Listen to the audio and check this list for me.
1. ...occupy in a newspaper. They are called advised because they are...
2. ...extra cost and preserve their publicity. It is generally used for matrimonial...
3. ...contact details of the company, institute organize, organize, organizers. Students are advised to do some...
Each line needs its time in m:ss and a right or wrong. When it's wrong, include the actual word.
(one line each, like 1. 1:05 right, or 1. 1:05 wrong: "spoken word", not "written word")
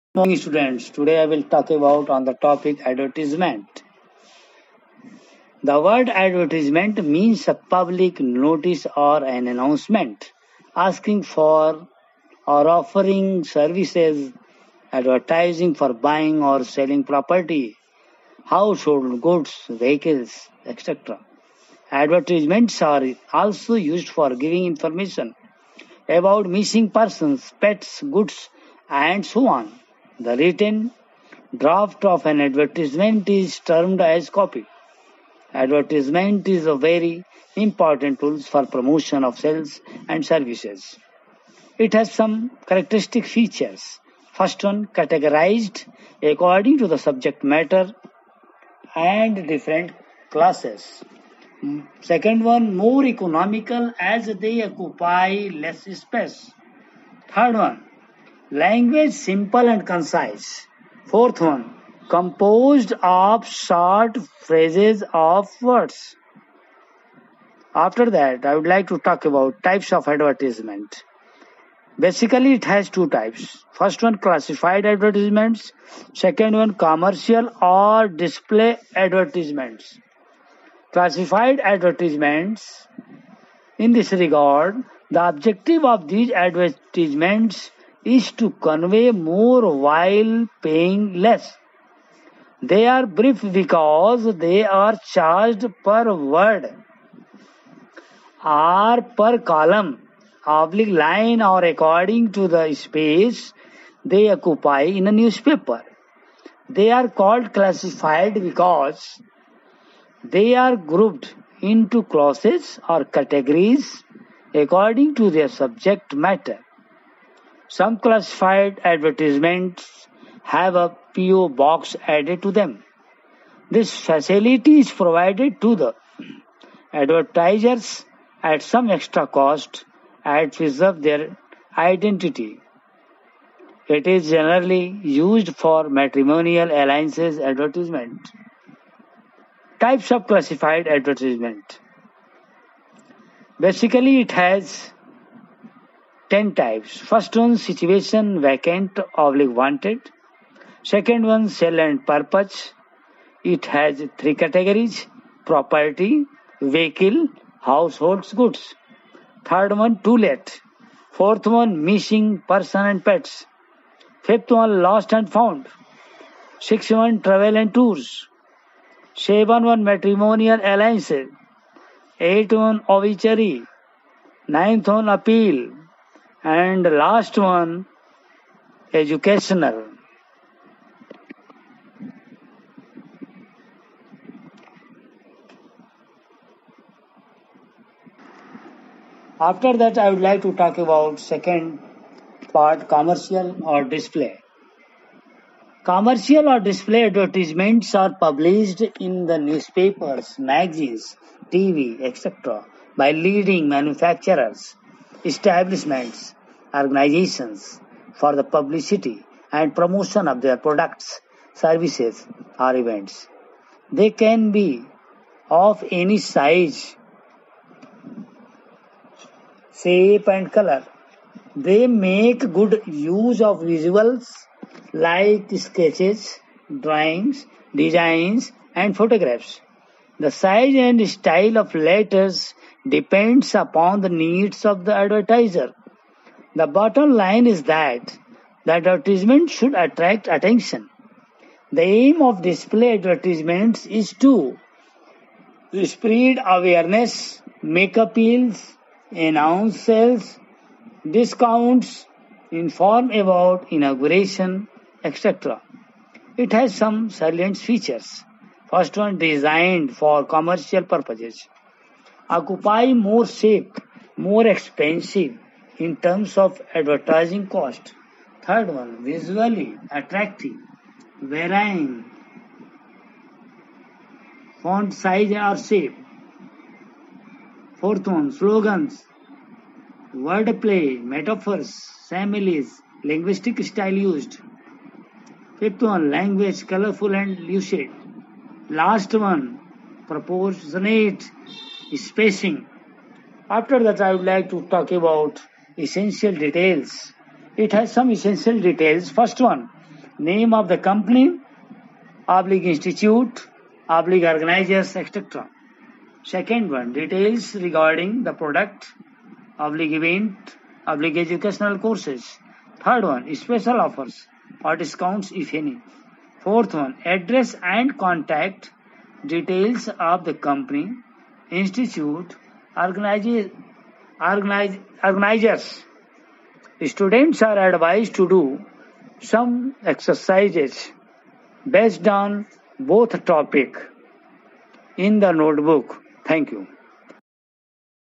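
1. 1:44 wrong: "classified", not "advised"
2. 2:08 wrong: "identity", not "publicity"
3. 5:17 right.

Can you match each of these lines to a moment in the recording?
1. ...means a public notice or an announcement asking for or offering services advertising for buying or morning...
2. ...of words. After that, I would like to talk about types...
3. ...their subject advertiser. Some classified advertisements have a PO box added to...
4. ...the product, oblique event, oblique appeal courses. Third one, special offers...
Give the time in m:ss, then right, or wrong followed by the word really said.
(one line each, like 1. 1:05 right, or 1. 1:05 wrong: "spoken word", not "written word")
1. 0:07 wrong: "selling", not "morning"
2. 1:05 right
3. 1:55 wrong: "matter", not "advertiser"
4. 5:08 wrong: "educational", not "appeal".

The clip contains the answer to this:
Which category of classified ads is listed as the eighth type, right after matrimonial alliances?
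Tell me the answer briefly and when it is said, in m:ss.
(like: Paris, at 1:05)
obituary, at 2:52.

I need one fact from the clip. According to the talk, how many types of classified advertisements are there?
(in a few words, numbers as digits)
10.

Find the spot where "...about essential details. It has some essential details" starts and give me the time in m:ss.
4:54.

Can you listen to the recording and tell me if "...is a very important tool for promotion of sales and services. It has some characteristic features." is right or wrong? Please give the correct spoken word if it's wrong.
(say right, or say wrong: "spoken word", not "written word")
right.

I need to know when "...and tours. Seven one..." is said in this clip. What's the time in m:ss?
2:47.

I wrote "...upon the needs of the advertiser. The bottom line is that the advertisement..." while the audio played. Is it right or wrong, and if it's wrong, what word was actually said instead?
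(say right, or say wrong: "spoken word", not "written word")
right.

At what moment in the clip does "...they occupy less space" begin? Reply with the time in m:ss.
0:54.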